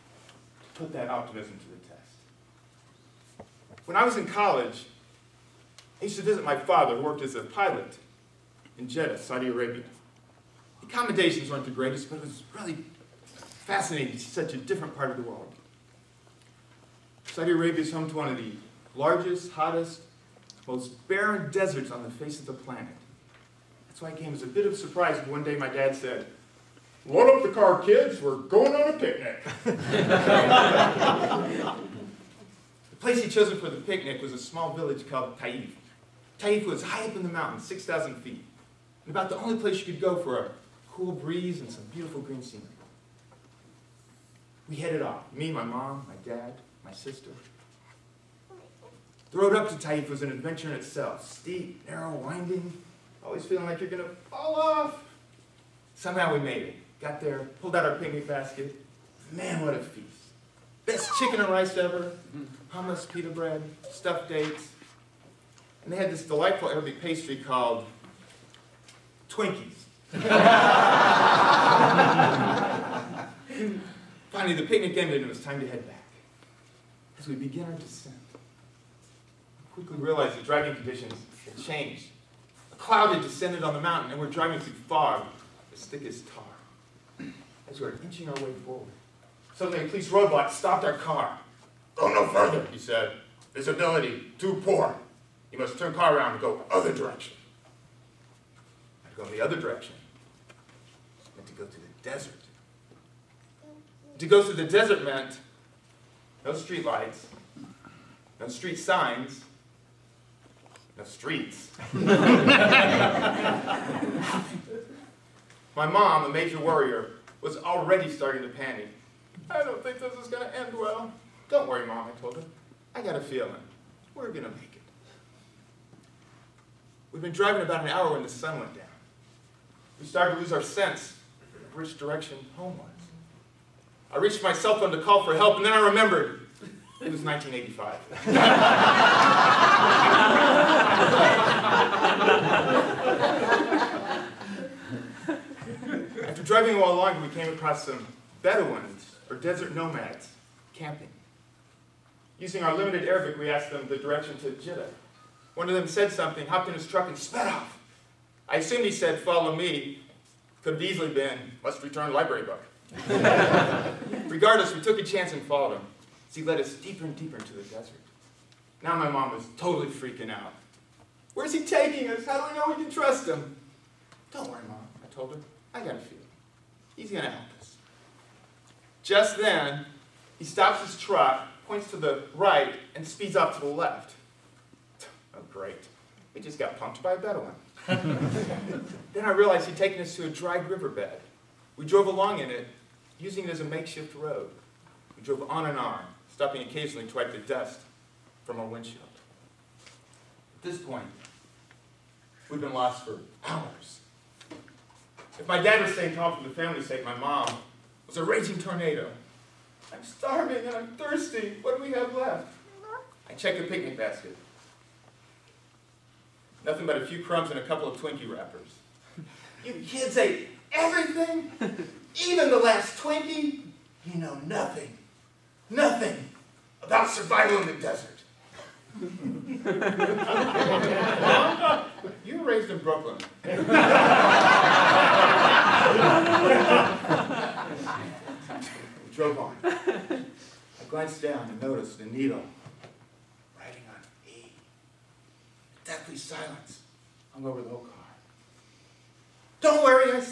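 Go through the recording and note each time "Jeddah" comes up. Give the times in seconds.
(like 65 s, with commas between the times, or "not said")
8 s, 154 s.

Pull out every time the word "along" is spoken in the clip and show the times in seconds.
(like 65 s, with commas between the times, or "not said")
192 s.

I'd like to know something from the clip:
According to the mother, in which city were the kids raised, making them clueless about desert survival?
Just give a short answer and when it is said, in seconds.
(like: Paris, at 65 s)
Brooklyn, at 232 s.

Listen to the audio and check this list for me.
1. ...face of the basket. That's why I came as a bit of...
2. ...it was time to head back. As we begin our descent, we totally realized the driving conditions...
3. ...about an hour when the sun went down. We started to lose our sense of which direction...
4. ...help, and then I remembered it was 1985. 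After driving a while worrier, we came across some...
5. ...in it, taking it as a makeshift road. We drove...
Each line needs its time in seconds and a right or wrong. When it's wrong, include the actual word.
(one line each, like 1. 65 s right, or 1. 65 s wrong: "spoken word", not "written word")
1. 22 s wrong: "planet", not "basket"
2. 75 s wrong: "quickly", not "totally"
3. 127 s right
4. 135 s wrong: "longer", not "worrier"
5. 192 s wrong: "using", not "taking".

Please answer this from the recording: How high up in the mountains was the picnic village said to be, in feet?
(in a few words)
6,000 feet.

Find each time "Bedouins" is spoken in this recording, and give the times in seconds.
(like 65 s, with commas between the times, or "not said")
148 s, 187 s.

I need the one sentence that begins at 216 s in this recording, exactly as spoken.
Nothing but a few crumbs and a couple of Twinkie wrappers.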